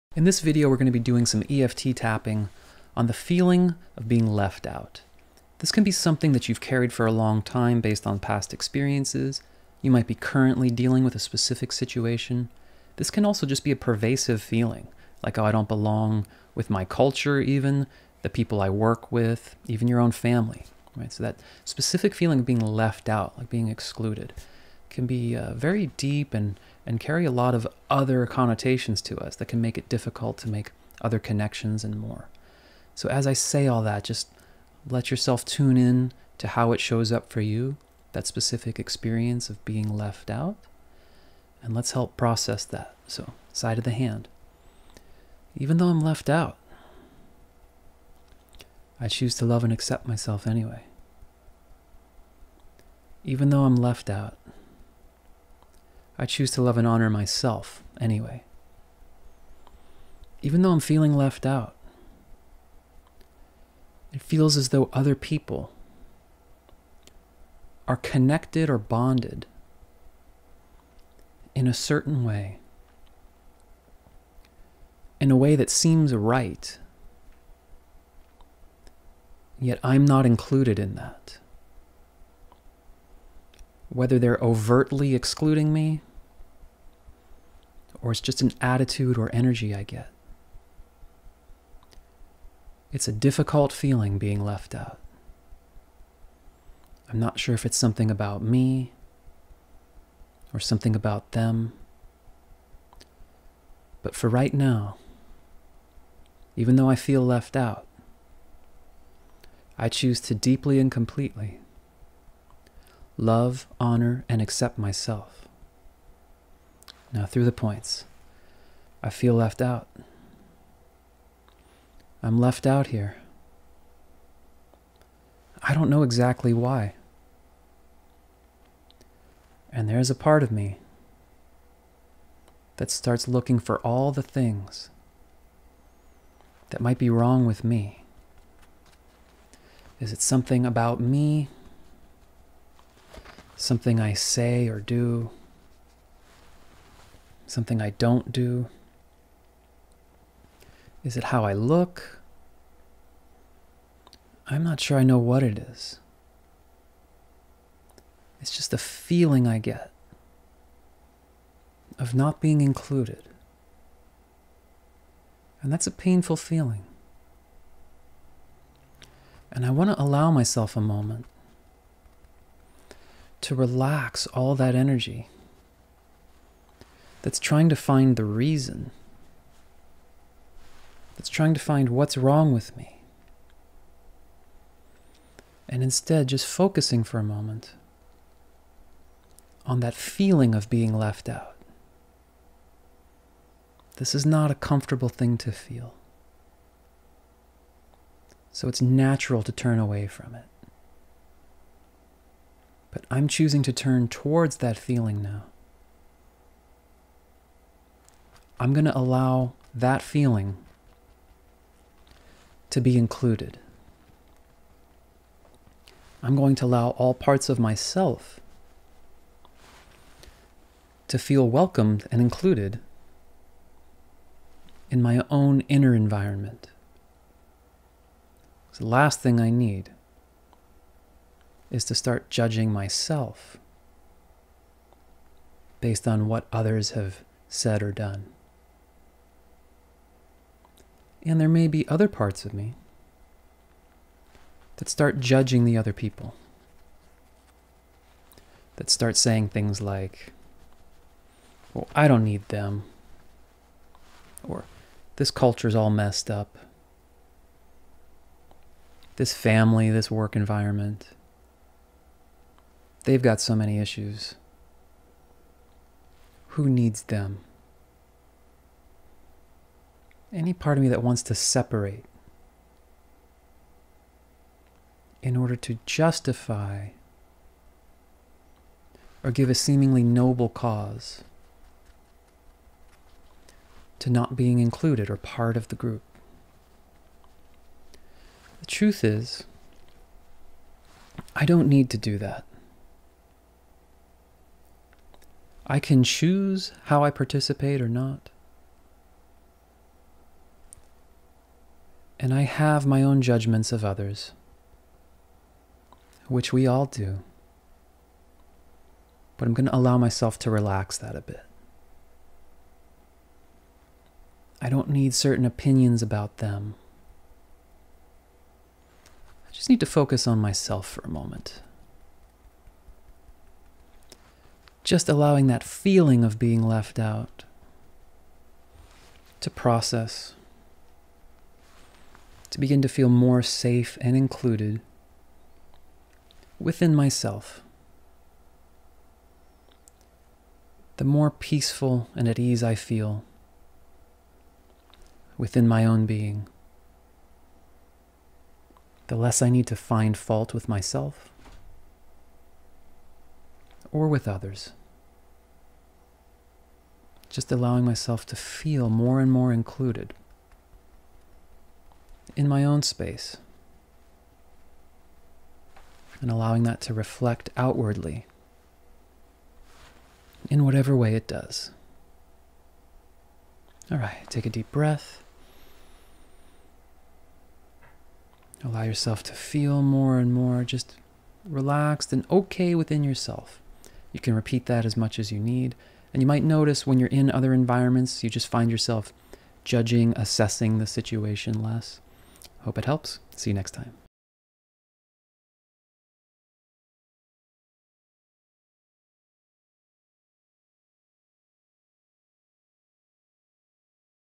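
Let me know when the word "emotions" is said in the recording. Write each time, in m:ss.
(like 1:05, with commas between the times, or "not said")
not said.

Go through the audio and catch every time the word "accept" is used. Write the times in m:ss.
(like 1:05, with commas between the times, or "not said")
0:49, 1:54.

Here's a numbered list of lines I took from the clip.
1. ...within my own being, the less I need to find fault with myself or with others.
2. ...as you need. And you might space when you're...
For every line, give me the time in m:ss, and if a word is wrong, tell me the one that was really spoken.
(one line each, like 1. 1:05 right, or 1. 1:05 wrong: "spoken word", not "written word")
1. 5:45 right
2. 6:25 wrong: "notice", not "space".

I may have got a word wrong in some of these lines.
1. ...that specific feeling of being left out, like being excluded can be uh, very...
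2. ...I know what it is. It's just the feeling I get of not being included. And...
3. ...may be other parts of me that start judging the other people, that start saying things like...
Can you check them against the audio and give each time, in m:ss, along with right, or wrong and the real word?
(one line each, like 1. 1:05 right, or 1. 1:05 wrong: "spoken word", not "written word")
1. 0:21 right
2. 2:34 right
3. 4:01 right.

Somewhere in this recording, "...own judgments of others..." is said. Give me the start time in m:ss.
5:03.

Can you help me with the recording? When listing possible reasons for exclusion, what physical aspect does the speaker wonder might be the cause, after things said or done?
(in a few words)
How I look.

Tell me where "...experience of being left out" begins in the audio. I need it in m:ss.
0:38.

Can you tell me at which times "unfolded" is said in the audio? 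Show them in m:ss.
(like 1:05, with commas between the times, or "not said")
not said.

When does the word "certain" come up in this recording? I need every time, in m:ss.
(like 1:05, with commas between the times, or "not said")
1:11, 5:15.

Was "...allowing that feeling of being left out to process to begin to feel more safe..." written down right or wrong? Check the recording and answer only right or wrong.
right.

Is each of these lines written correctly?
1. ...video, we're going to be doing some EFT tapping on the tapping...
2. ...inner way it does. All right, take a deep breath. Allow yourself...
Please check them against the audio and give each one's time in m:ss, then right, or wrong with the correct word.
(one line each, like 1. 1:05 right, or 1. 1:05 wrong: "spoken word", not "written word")
1. 0:00 wrong: "feeling", not "tapping"
2. 6:10 wrong: "whatever", not "inner".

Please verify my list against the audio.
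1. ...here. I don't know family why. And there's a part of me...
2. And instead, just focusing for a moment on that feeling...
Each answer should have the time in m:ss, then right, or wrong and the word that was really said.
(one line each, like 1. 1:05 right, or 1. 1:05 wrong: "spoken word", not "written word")
1. 2:02 wrong: "exactly", not "family"
2. 3:05 right.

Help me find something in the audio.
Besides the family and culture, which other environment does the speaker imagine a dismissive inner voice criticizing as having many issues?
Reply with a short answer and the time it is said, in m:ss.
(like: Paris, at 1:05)
Work environment, at 4:20.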